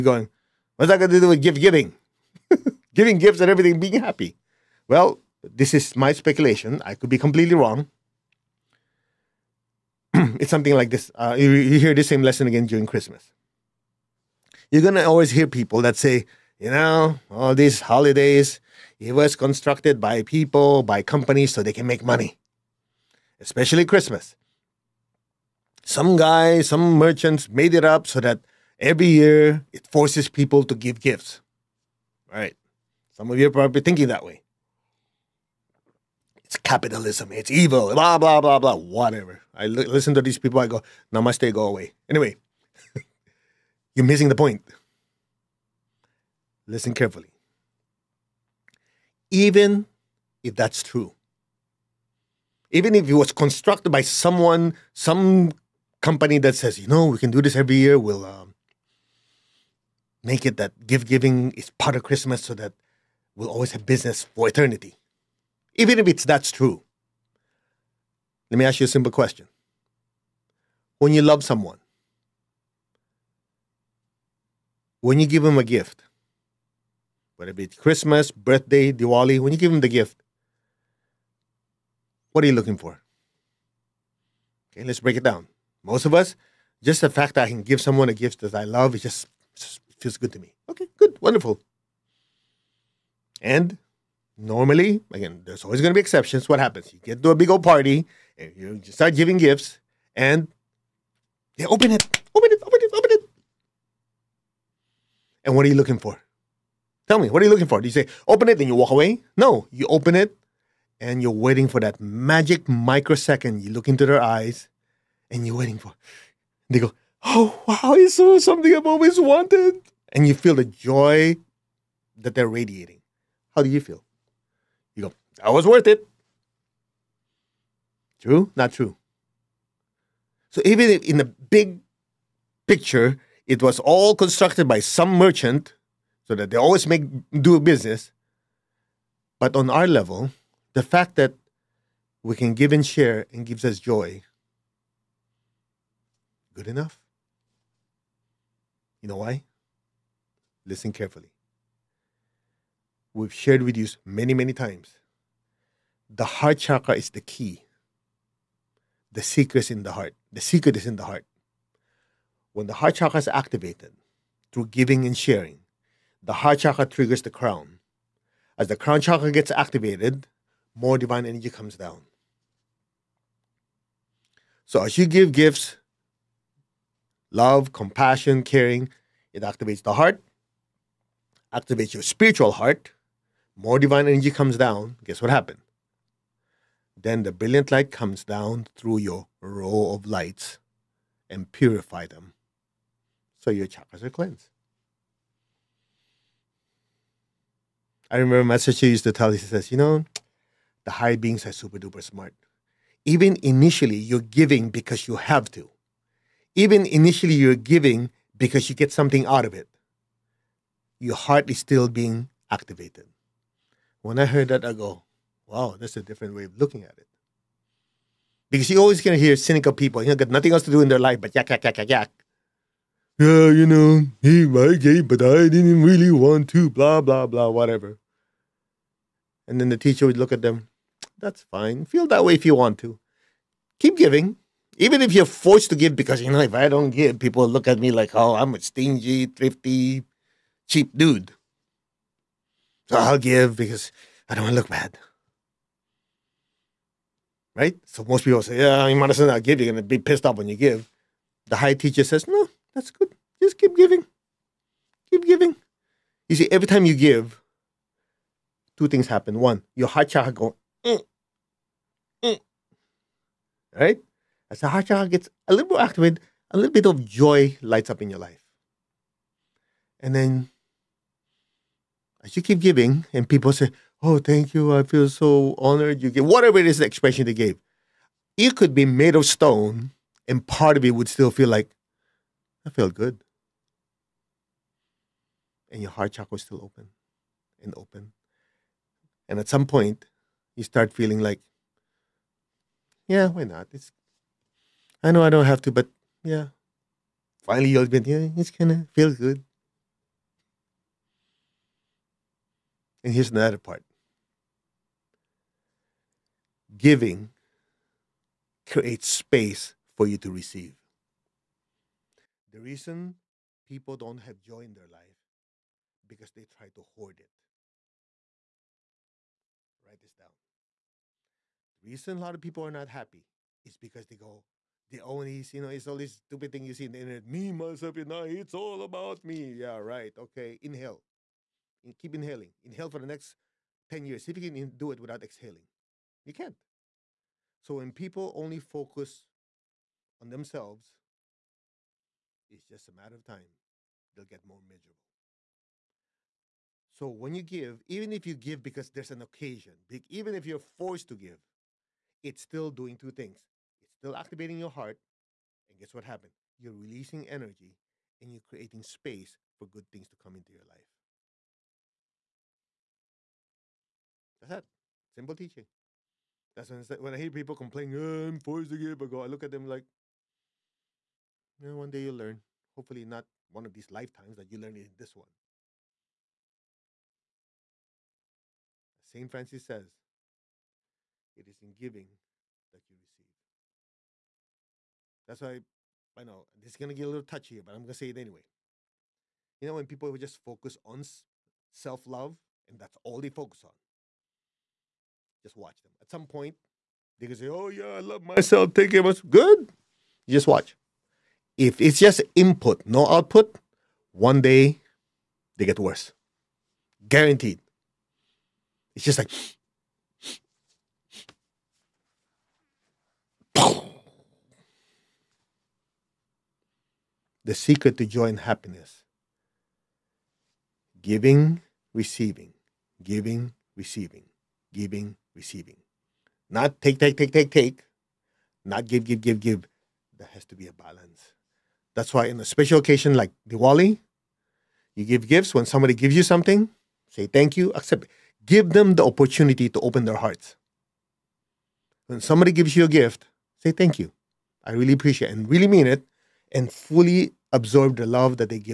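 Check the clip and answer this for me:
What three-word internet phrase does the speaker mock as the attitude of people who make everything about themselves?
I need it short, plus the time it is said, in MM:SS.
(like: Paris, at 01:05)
Me, myself, and I, at 05:27.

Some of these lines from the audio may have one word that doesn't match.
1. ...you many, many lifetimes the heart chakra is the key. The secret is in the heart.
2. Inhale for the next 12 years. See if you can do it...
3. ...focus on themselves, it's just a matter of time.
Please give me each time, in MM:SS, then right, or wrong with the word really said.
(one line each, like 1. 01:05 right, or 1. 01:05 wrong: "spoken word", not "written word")
1. 02:33 wrong: "times", not "lifetimes"
2. 05:32 wrong: "10", not "12"
3. 05:38 right.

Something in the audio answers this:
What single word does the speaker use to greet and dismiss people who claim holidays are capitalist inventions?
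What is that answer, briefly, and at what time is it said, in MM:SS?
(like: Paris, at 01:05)
namaste, at 00:41.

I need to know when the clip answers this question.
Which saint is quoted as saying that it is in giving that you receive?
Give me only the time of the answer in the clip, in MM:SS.
06:18.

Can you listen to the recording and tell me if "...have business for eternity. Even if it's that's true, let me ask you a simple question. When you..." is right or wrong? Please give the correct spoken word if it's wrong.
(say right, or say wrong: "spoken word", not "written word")
right.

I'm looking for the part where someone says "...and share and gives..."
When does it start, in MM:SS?
02:22.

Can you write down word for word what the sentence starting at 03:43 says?
Yeah, you know, he might gay, but I didn't really want to, blah, blah, blah, whatever.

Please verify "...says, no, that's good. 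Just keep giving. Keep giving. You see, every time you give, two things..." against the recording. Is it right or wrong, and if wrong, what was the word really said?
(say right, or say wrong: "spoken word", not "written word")
right.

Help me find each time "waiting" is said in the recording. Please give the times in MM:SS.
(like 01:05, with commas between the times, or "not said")
01:51, 01:55.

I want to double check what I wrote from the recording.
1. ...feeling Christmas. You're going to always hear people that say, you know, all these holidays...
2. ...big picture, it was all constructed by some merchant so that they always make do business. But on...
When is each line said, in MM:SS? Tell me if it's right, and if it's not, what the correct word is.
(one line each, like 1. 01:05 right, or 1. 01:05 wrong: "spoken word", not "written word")
1. 00:12 wrong: "during", not "feeling"
2. 02:11 right.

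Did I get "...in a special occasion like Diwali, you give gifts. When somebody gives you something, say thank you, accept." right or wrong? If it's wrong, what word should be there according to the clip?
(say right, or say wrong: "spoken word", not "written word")
right.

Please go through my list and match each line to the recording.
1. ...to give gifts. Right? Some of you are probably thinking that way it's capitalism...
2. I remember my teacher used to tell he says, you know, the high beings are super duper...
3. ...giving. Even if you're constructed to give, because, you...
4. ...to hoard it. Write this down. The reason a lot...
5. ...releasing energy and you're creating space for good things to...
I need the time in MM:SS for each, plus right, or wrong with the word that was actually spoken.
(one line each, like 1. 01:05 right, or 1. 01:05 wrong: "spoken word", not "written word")
1. 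00:30 right
2. 03:18 right
3. 03:53 wrong: "forced", not "constructed"
4. 05:16 right
5. 05:56 right.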